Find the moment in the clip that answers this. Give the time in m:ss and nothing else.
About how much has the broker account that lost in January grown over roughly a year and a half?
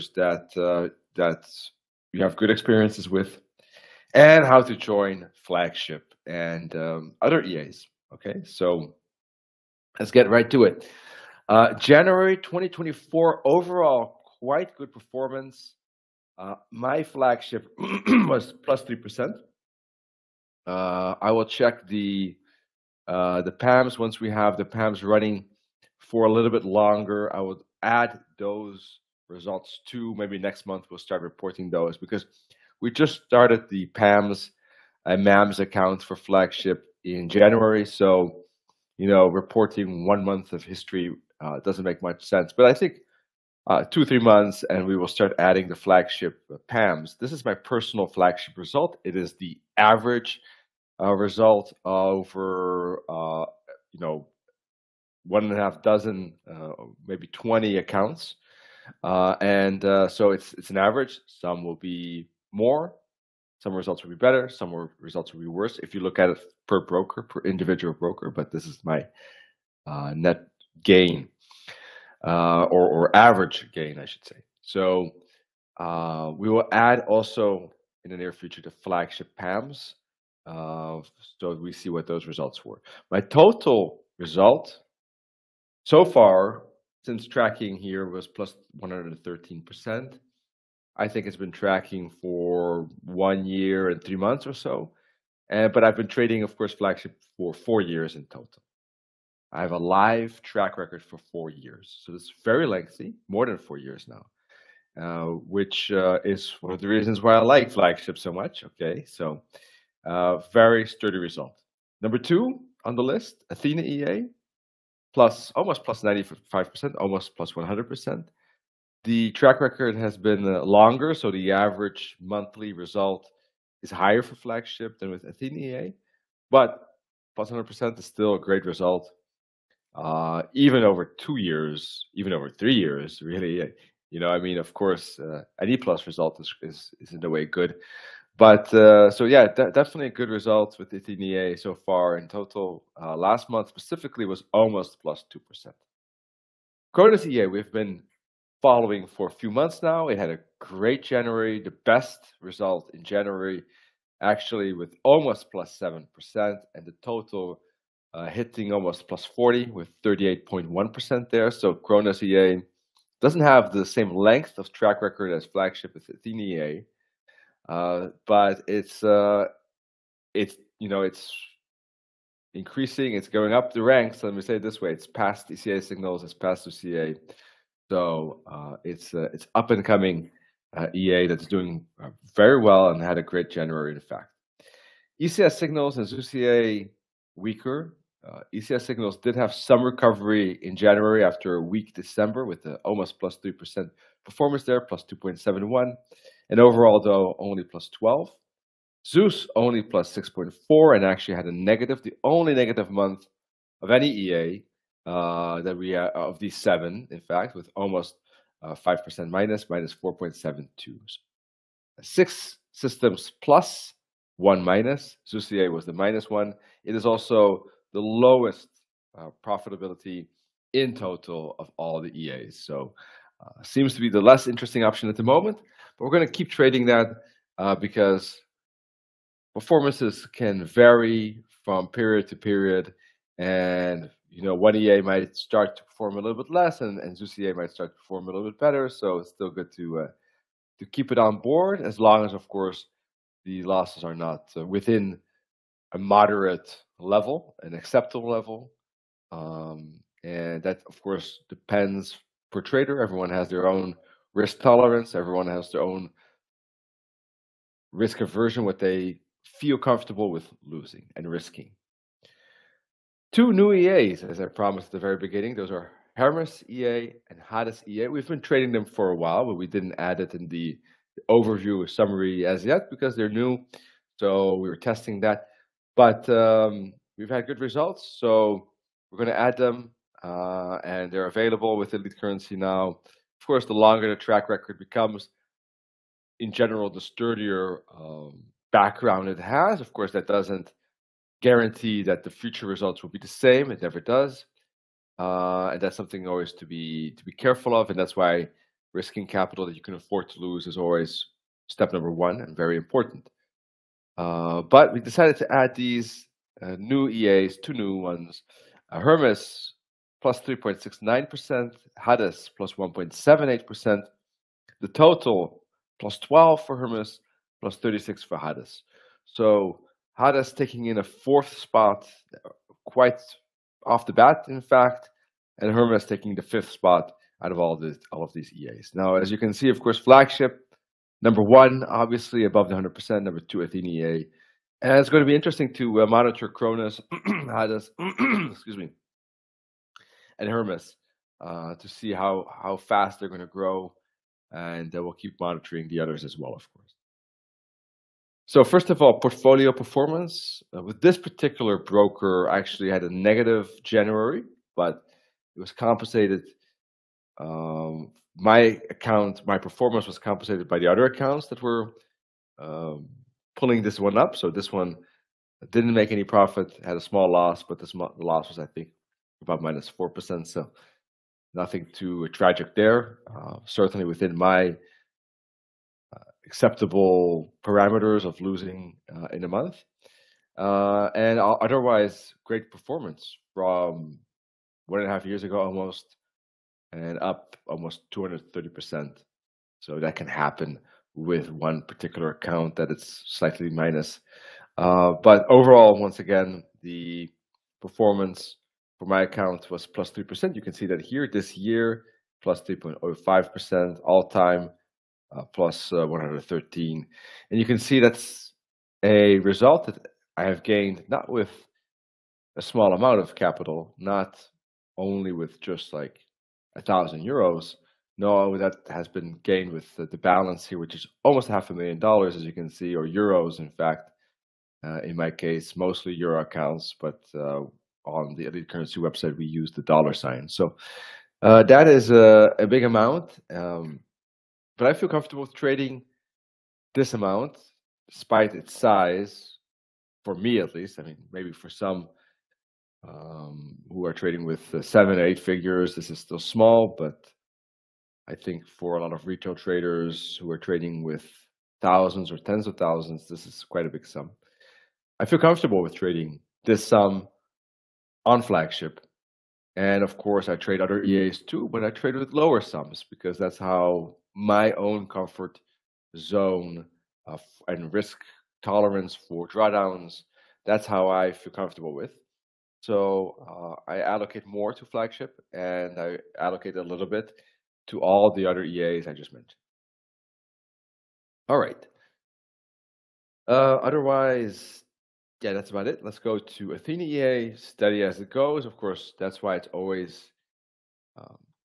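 6:28.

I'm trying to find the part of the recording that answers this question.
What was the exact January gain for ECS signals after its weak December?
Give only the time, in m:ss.
3:14.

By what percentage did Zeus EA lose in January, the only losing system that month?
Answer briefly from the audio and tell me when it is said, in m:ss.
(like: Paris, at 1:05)
-4.72%, at 3:29.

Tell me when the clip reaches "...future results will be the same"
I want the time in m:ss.
4:52.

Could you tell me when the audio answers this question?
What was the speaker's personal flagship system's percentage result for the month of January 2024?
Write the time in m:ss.
0:18.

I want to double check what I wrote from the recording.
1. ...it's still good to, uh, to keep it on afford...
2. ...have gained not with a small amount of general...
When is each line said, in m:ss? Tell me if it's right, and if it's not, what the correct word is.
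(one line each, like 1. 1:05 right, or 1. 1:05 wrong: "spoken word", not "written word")
1. 3:59 wrong: "board", not "afford"
2. 6:50 wrong: "capital", not "general".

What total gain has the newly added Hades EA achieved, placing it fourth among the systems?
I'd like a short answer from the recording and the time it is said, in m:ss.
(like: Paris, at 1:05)
36%, at 5:17.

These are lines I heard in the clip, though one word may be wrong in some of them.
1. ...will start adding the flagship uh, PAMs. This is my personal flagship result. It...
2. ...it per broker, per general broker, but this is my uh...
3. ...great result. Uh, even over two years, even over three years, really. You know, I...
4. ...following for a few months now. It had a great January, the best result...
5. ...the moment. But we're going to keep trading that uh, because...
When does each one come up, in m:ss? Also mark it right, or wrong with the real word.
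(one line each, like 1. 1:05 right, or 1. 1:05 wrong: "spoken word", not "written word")
1. 0:44 right
2. 1:06 wrong: "individual", not "general"
3. 2:08 right
4. 2:28 right
5. 3:45 right.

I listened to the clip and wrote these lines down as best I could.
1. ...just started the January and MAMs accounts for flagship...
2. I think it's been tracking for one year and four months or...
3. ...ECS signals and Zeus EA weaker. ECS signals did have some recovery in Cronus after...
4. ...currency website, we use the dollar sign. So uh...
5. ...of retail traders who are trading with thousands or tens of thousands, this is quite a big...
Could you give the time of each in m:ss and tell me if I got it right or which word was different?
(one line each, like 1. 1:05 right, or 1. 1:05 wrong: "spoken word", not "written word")
1. 0:32 wrong: "PAMs", not "January"
2. 1:30 wrong: "three", not "four"
3. 3:05 wrong: "January", not "Cronus"
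4. 7:08 right
5. 7:29 right.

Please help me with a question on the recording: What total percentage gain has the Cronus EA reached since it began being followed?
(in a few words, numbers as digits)
38.1%.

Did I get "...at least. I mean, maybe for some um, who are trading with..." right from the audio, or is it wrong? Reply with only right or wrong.
right.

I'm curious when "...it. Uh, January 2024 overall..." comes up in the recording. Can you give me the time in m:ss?
0:10.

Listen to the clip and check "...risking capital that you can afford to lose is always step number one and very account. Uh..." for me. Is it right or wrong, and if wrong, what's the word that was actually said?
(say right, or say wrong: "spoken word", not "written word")
wrong: "important", not "account".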